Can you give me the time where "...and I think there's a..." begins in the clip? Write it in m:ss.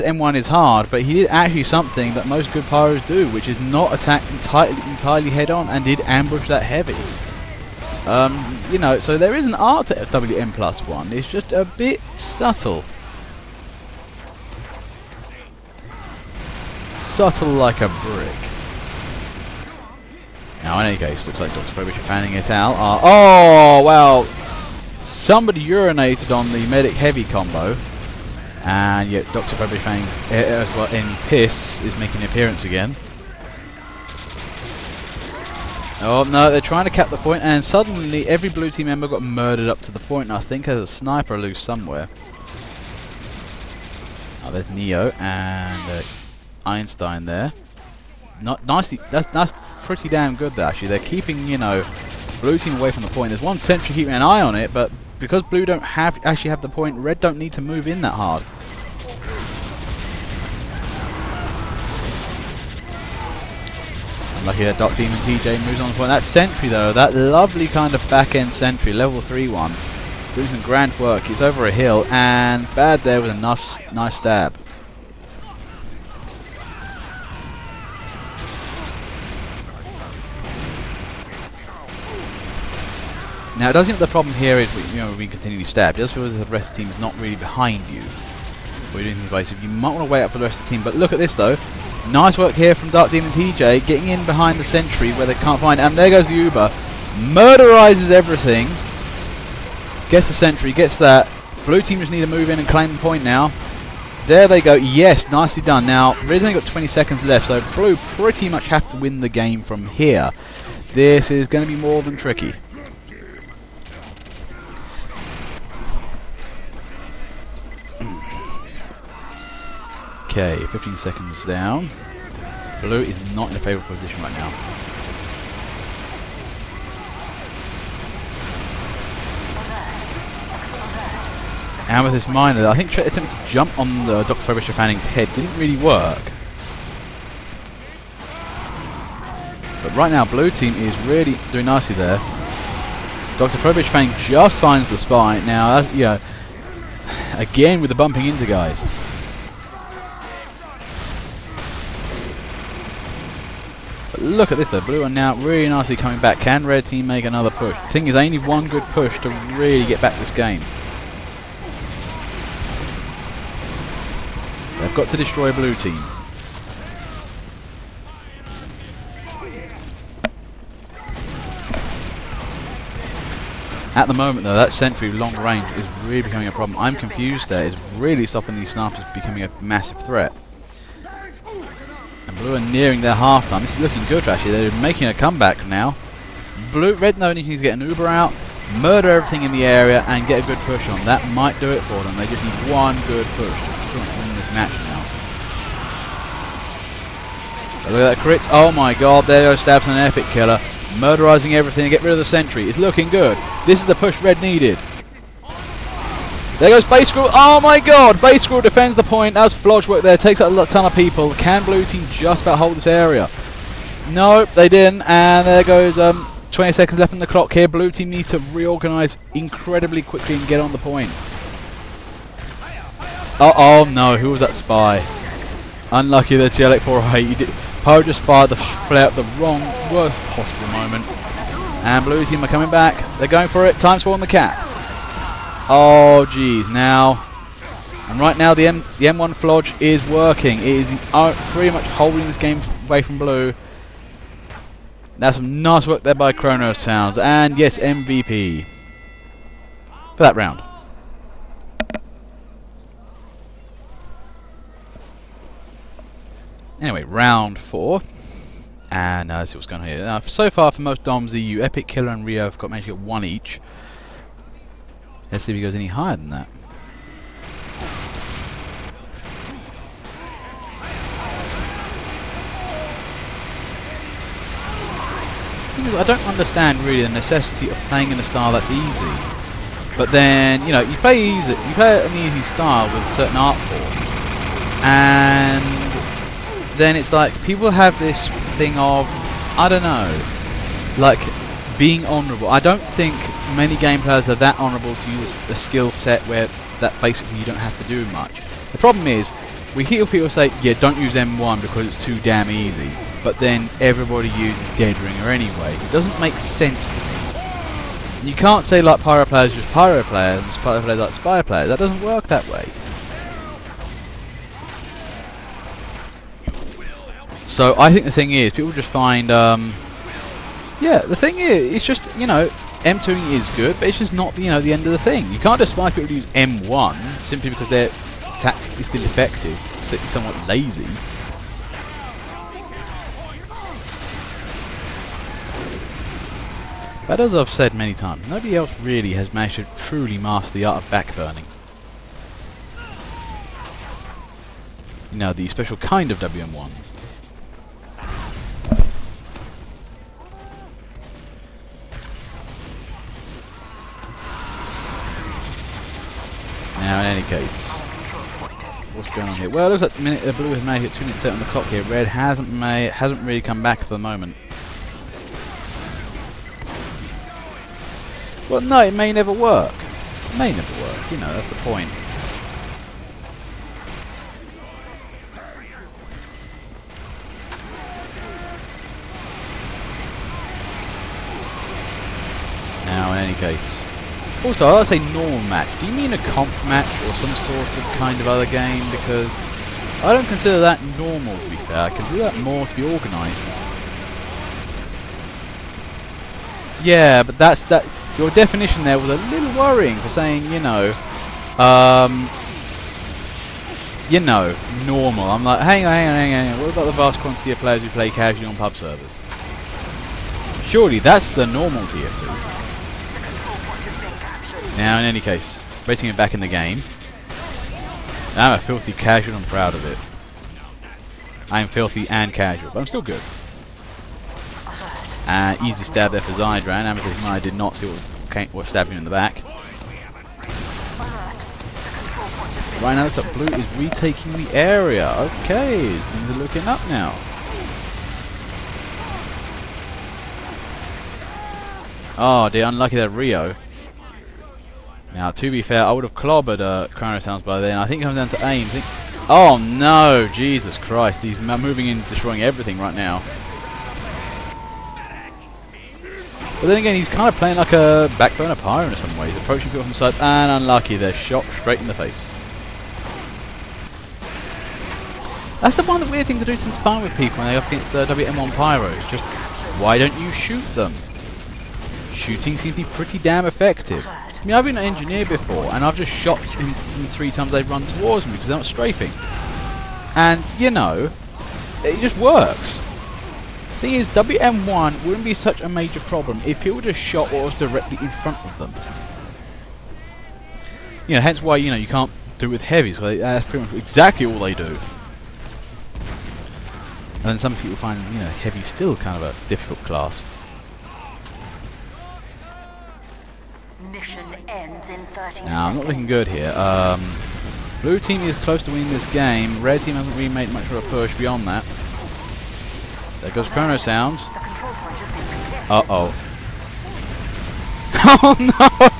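0:40.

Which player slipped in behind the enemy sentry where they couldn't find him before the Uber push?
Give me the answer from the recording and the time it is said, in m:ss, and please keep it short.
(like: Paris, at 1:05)
Dark Demon TJ, at 1:32.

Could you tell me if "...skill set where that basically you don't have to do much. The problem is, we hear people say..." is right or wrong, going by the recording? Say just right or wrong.
right.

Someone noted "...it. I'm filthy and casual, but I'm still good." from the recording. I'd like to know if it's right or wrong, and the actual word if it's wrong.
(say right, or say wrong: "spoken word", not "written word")
right.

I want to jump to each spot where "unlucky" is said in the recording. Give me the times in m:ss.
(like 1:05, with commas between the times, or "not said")
3:45, 7:22, 7:40.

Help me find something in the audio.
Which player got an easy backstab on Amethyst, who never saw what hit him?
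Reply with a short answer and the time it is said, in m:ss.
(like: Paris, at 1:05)
Zydran, at 7:06.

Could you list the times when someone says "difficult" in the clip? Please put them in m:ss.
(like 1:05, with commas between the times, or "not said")
8:19.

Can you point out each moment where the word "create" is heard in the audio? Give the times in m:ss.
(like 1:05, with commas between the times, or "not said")
not said.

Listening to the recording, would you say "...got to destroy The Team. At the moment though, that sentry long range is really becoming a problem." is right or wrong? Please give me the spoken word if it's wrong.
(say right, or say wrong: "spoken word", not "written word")
wrong: "Blue", not "The".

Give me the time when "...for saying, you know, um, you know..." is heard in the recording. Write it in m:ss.
6:39.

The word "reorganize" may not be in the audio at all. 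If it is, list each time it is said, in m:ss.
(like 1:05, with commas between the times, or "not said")
3:38.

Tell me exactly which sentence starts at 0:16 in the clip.
Subtle like a brick any Case.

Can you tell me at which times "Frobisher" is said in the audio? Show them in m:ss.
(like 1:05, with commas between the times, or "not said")
0:21, 0:29, 2:14, 2:23.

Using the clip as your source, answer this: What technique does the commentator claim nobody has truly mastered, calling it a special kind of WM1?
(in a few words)
backburning.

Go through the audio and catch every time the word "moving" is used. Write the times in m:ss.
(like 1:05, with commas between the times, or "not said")
7:31.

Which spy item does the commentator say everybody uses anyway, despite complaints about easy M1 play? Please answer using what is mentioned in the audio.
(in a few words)
Dead Ringer.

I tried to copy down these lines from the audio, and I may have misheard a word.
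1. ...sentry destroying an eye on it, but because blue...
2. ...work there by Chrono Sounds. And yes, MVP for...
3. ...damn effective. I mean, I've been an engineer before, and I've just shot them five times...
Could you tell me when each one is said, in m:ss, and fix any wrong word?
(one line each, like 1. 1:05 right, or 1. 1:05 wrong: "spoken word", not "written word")
1. 0:53 wrong: "keeping", not "destroying"
2. 4:05 right
3. 7:53 wrong: "three", not "five".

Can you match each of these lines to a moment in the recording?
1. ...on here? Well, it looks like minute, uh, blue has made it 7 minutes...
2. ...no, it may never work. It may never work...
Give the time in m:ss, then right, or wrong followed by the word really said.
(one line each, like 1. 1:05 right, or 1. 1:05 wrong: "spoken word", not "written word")
1. 5:59 wrong: "2", not "7"
2. 6:08 right.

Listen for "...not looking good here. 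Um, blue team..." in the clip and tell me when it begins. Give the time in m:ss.
8:25.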